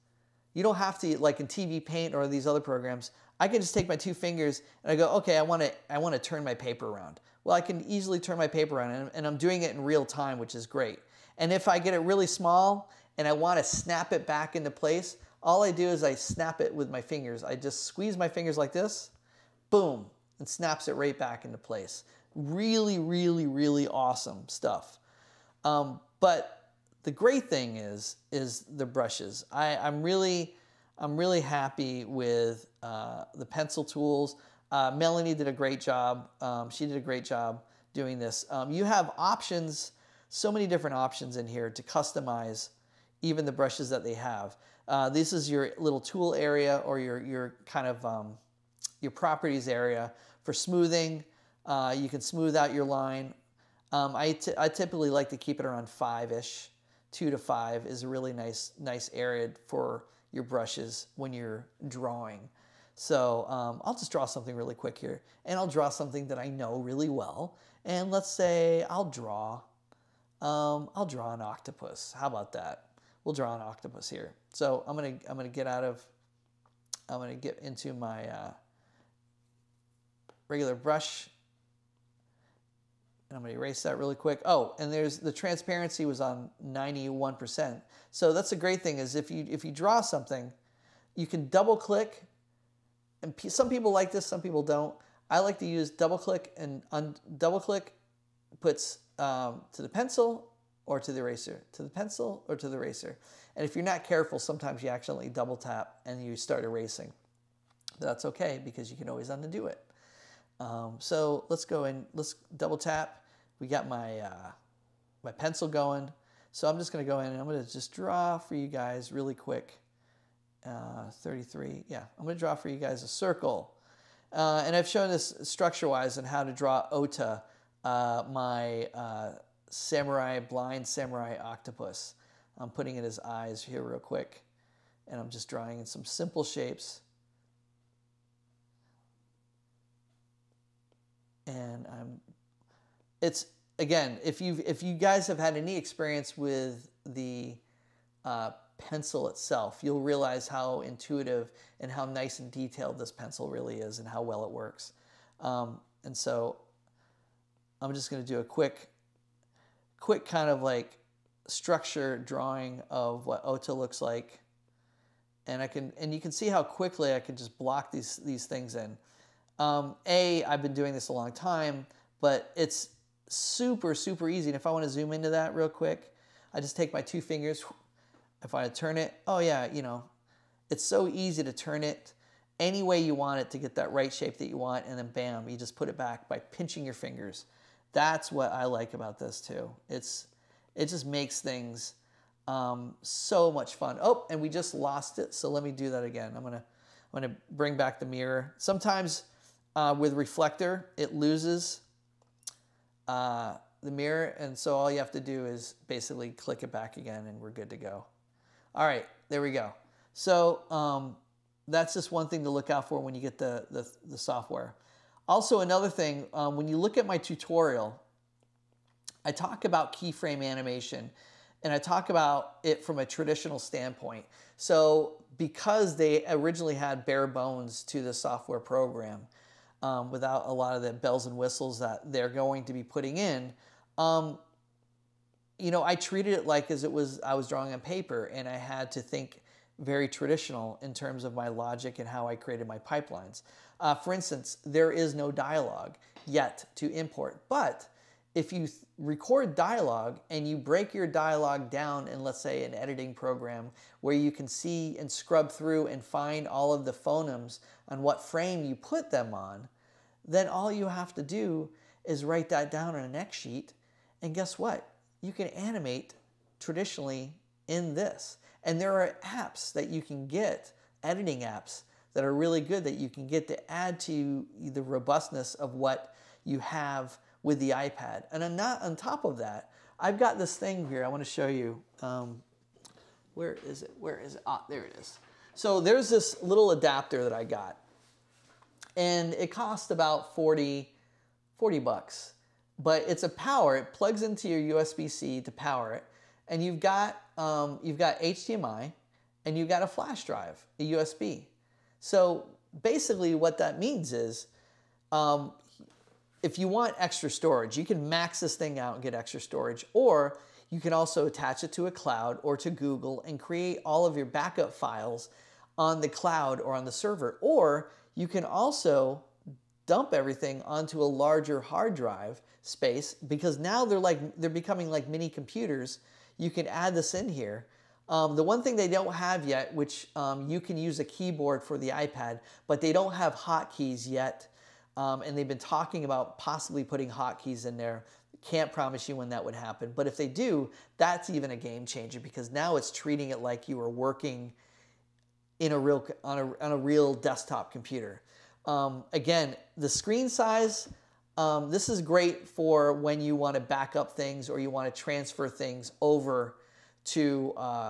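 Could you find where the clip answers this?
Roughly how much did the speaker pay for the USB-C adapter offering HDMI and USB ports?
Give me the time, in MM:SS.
04:51.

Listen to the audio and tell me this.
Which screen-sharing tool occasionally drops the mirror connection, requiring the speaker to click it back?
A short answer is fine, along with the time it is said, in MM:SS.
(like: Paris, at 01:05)
Reflector, at 03:20.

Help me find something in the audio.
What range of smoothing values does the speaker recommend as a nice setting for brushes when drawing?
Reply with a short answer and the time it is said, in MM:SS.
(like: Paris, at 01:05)
2 to 5, at 00:57.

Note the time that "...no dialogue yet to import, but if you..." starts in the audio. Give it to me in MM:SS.
04:05.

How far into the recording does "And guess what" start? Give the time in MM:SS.
04:24.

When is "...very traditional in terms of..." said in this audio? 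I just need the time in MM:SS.
03:59.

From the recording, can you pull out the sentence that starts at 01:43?
And if you're not careful, sometimes you accidentally double tap and you start erasing.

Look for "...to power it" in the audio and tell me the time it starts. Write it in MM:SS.
04:55.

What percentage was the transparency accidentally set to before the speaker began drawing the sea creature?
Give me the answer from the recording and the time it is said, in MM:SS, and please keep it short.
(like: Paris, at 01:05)
91%, at 01:26.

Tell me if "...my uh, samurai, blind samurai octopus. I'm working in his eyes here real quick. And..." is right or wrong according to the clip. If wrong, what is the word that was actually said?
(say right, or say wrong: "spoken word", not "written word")
wrong: "putting", not "working".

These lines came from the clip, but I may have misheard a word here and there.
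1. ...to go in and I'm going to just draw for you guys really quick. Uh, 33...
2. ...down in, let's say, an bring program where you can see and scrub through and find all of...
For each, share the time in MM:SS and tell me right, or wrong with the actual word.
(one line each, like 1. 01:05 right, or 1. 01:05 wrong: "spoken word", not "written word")
1. 01:57 right
2. 04:11 wrong: "editing", not "bring".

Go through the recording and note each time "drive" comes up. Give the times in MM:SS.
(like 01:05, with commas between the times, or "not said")
05:00, 05:21.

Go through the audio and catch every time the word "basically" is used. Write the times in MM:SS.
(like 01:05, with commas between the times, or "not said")
03:25, 05:02.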